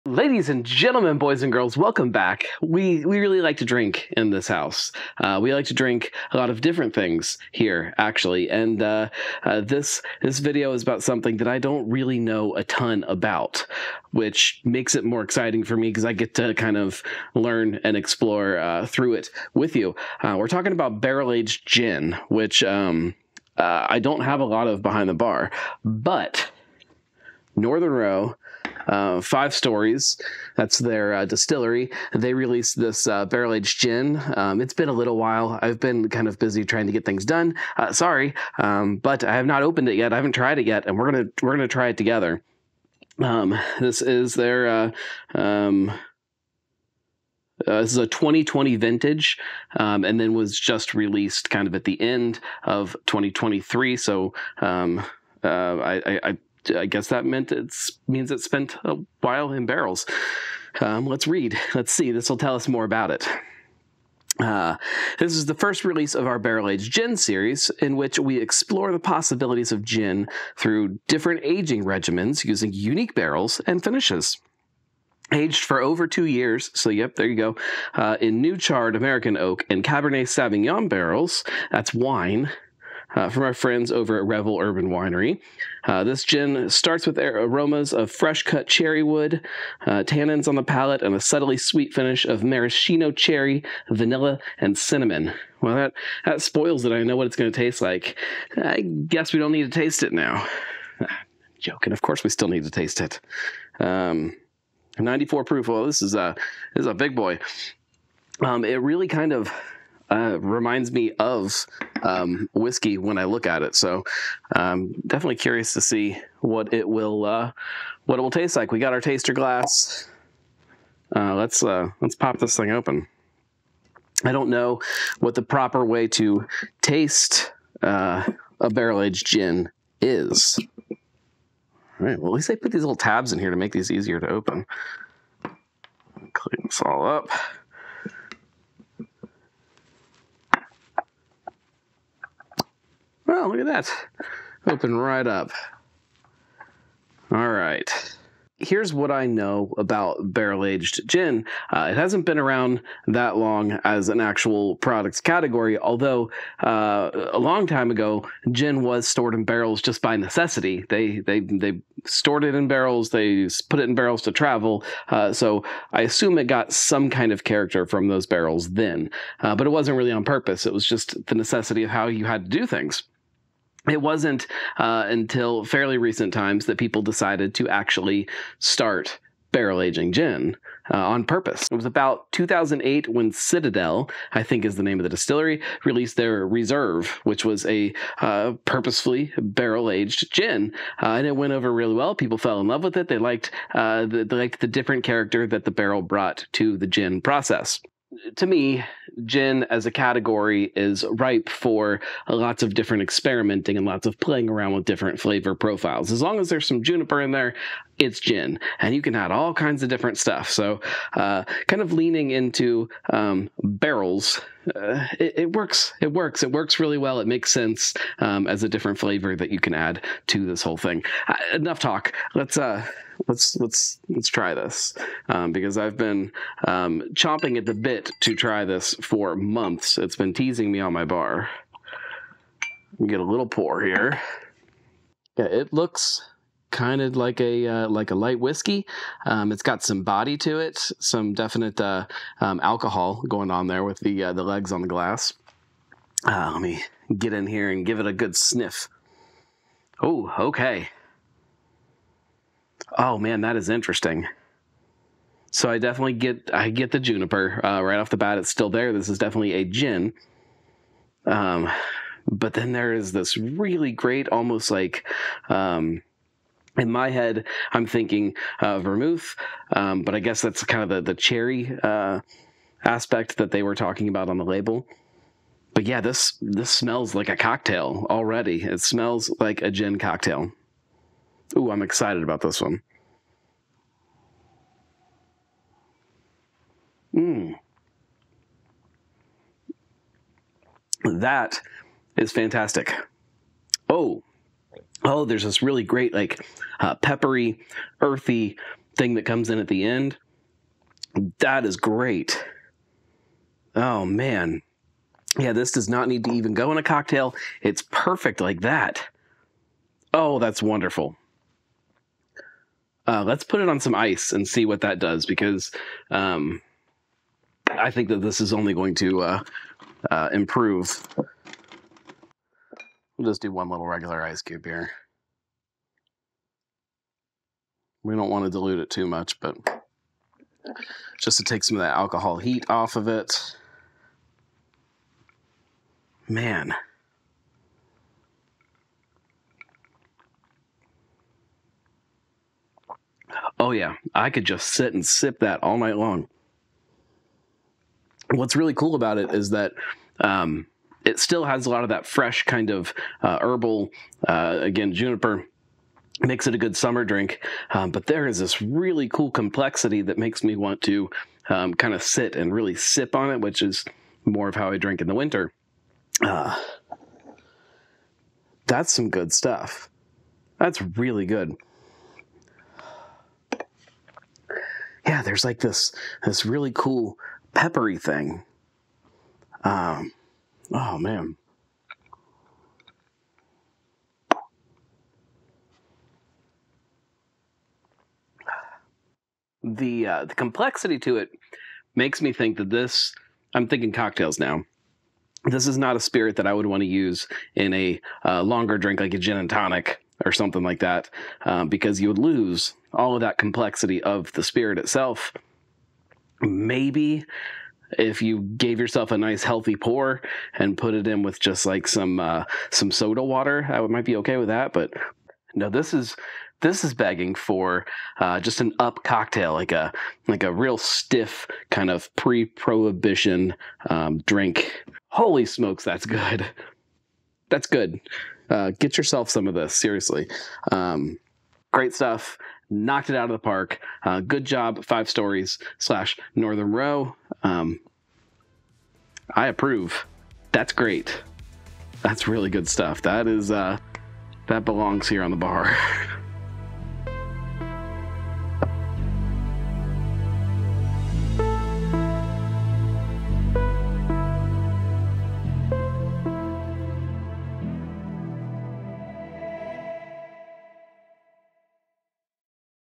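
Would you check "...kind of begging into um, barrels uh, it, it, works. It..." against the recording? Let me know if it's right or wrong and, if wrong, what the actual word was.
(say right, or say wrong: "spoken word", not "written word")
wrong: "leaning", not "begging".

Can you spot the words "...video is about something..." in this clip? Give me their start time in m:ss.
0:10.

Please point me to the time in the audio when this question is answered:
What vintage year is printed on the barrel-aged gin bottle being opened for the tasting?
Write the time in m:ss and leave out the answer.
0:48.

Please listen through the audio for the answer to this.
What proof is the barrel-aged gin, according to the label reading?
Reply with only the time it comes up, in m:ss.
1:44.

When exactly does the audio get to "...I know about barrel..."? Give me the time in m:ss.
2:29.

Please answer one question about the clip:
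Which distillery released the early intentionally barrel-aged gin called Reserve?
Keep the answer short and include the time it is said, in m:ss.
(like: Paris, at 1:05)
Citadelle, at 3:03.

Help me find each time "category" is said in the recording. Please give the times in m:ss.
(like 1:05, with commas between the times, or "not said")
2:35, 3:19.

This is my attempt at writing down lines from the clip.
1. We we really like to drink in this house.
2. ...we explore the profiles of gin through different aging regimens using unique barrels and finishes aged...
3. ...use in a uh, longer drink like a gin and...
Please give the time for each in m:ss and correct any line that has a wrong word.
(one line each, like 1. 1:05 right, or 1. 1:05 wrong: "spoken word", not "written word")
1. 0:02 right
2. 1:08 wrong: "possibilities", not "profiles"
3. 6:36 right.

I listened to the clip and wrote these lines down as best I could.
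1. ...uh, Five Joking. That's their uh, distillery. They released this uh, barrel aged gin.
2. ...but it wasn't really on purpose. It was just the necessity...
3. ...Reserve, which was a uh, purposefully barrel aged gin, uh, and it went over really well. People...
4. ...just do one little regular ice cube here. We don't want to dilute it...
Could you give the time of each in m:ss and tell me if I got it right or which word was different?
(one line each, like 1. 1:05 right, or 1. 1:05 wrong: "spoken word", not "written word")
1. 0:28 wrong: "Stories", not "Joking"
2. 2:49 right
3. 3:06 right
4. 5:23 right.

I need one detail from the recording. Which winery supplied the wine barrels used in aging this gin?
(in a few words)
Revel Urban Winery.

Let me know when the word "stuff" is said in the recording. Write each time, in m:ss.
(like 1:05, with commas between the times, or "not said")
3:30, 6:09, 7:11, 7:22.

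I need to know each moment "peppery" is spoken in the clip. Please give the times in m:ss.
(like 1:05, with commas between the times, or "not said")
4:56, 6:17.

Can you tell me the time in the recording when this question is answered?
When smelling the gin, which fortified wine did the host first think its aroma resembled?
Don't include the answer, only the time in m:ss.
4:28.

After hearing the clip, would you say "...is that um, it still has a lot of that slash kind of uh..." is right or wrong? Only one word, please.
wrong.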